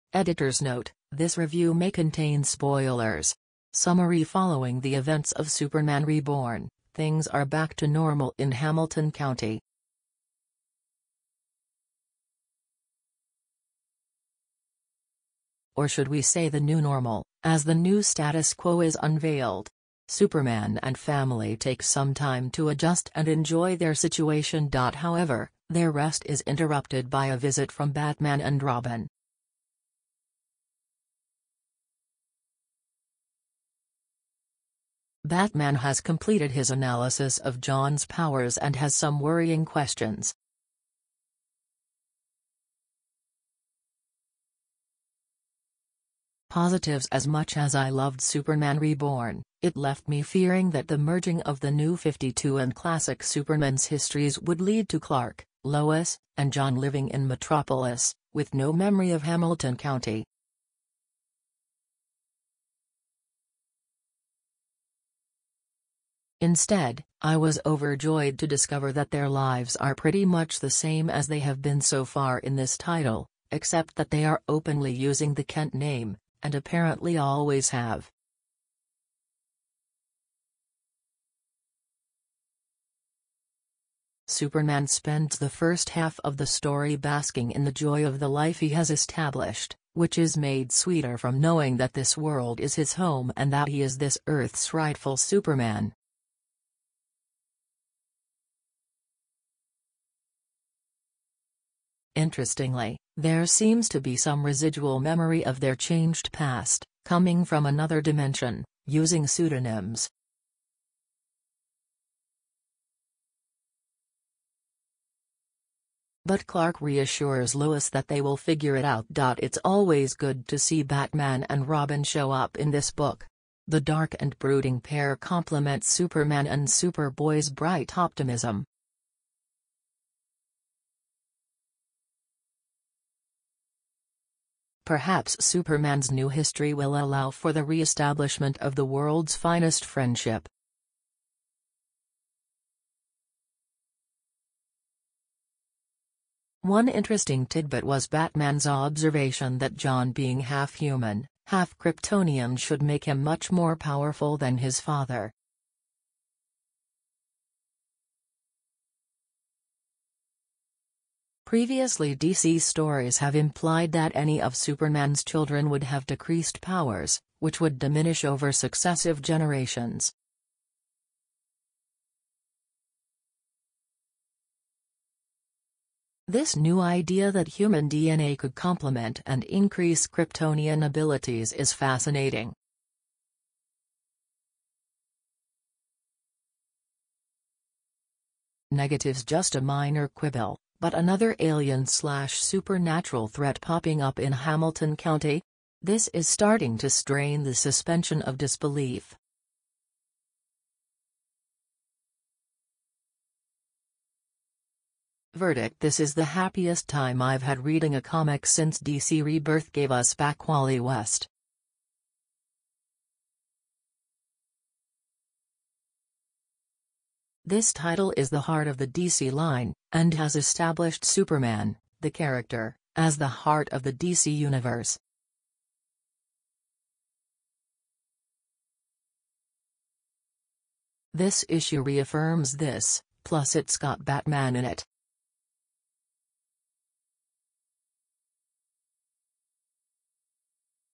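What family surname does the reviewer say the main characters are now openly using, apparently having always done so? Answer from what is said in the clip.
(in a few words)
Kent.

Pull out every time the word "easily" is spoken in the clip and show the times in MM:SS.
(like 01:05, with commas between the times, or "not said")
not said.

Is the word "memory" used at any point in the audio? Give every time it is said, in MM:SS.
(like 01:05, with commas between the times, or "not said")
00:58, 01:44.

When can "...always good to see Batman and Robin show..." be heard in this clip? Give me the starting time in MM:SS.
01:59.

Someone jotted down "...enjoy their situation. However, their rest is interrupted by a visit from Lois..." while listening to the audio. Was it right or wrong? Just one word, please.
wrong.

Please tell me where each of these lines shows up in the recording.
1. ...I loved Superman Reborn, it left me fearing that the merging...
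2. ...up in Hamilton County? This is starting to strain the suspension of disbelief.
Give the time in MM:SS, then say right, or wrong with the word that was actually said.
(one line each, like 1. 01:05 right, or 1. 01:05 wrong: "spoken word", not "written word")
1. 00:47 right
2. 03:14 right.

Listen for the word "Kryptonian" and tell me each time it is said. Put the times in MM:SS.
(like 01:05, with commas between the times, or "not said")
02:31, 03:00.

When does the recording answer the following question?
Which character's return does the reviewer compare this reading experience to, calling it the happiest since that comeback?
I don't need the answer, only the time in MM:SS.
03:30.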